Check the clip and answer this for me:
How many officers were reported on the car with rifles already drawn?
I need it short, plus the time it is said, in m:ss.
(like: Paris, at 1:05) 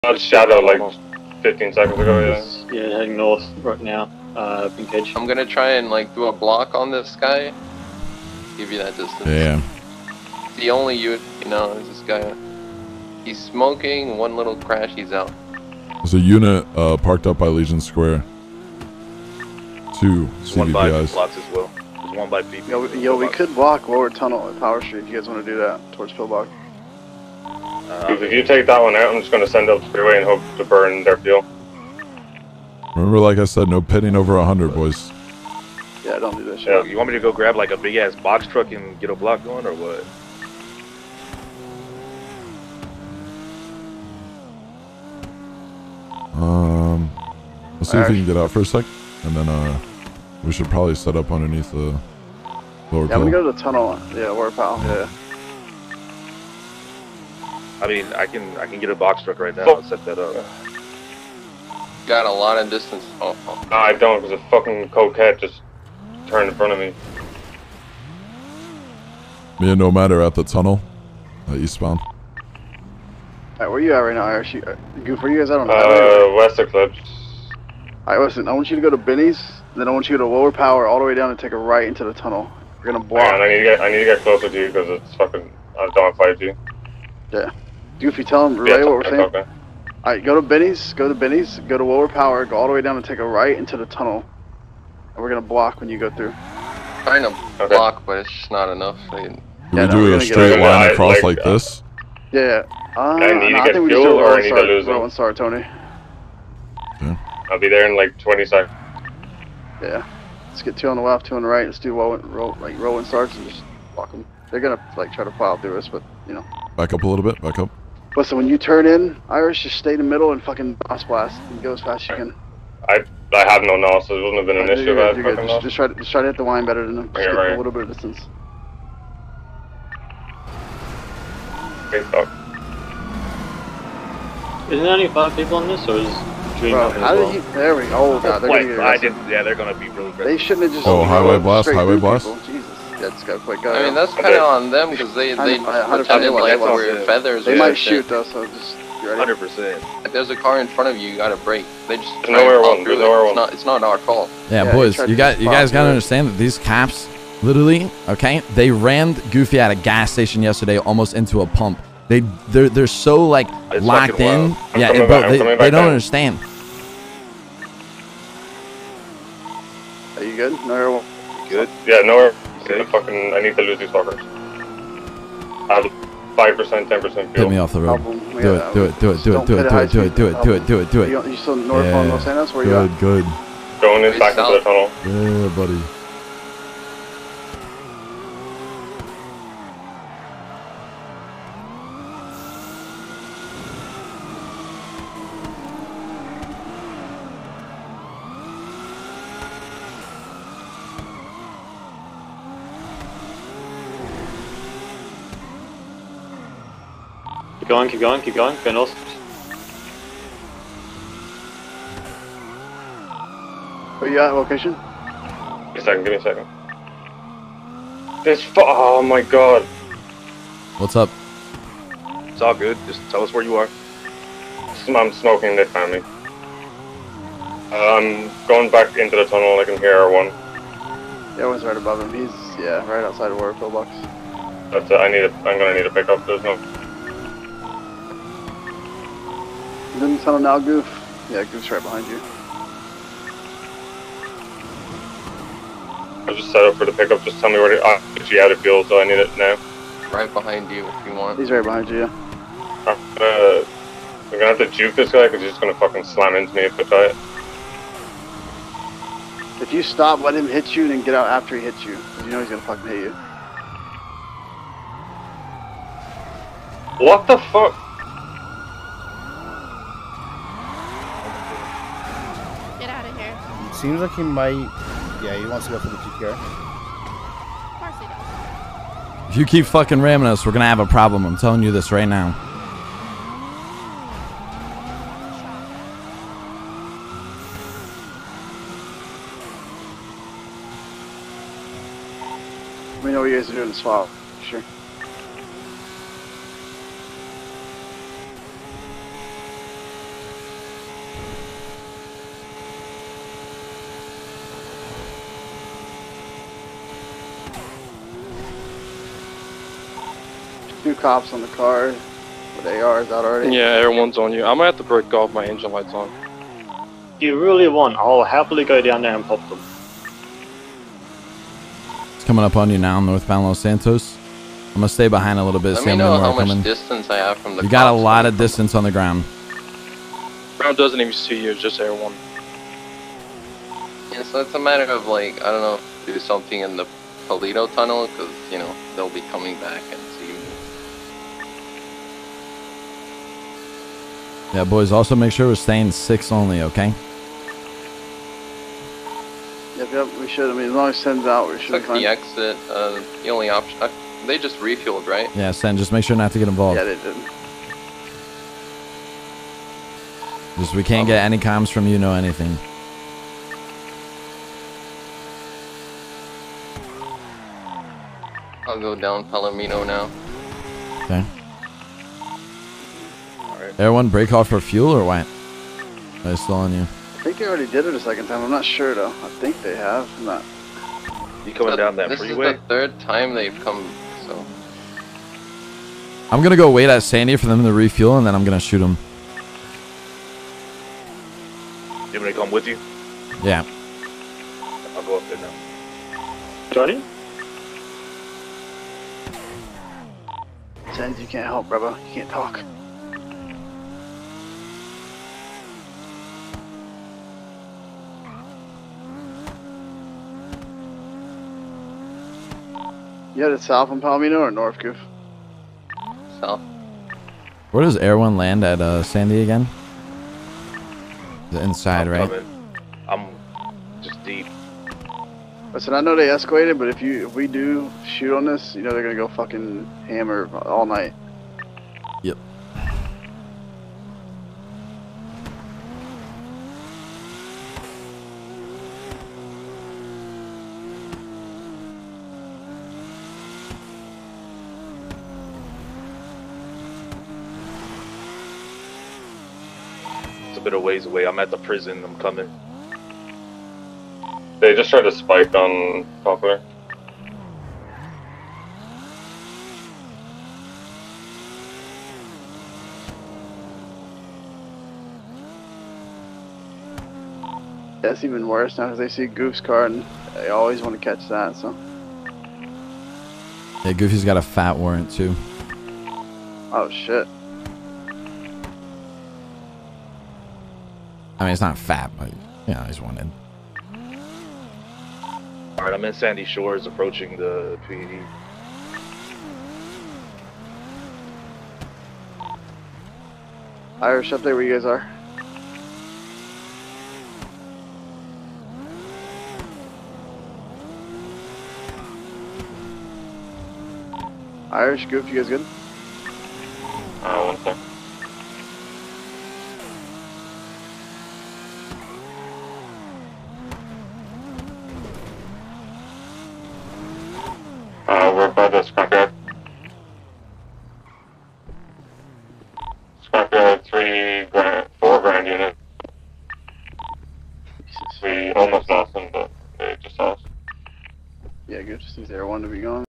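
2, at 5:10.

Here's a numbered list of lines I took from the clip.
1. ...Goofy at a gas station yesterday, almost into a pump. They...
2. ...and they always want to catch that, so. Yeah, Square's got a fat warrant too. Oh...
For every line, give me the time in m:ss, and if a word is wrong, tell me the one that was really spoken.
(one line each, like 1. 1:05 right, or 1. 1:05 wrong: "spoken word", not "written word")
1. 2:39 right
2. 7:49 wrong: "Goofy", not "Square".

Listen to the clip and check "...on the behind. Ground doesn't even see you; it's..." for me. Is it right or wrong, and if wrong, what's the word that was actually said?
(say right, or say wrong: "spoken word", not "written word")
wrong: "ground", not "behind".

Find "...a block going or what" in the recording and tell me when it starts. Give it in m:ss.
0:39.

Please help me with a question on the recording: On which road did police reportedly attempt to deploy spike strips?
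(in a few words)
Poplar.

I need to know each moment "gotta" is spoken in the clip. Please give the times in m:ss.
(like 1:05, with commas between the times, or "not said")
2:31, 2:35.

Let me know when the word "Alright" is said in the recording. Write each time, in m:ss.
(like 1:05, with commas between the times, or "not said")
1:13, 1:18.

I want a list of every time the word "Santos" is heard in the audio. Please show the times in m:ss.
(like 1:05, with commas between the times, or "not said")
5:23.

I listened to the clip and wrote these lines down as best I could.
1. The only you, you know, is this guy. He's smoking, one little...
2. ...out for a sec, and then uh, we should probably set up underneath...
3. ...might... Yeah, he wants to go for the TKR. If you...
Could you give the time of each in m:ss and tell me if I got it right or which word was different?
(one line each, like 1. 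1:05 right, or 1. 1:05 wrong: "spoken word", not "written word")
1. 0:10 right
2. 0:48 right
3. 4:34 right.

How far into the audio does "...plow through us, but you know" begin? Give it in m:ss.
1:55.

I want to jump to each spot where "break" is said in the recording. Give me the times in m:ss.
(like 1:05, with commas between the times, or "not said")
5:14, 6:14.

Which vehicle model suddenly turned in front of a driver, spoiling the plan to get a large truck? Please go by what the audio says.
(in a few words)
Coquette.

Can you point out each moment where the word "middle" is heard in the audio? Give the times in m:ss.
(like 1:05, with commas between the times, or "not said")
2:00.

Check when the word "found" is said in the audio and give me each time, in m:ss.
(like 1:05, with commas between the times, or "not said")
3:45.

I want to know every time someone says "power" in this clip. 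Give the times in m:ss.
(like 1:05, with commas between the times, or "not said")
0:24, 1:20, 1:32.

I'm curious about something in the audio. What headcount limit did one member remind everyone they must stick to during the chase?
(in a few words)
6.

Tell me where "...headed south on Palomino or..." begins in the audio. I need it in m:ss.
6:53.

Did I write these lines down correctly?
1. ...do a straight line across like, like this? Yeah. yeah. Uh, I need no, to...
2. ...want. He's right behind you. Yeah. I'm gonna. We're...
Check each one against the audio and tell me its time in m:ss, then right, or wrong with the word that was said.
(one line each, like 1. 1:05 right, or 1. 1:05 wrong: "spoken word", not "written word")
1. 1:39 right
2. 4:11 right.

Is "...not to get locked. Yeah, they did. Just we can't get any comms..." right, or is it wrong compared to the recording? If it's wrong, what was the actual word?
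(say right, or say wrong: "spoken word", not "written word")
wrong: "involved", not "locked".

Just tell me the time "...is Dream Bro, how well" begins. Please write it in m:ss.
2:15.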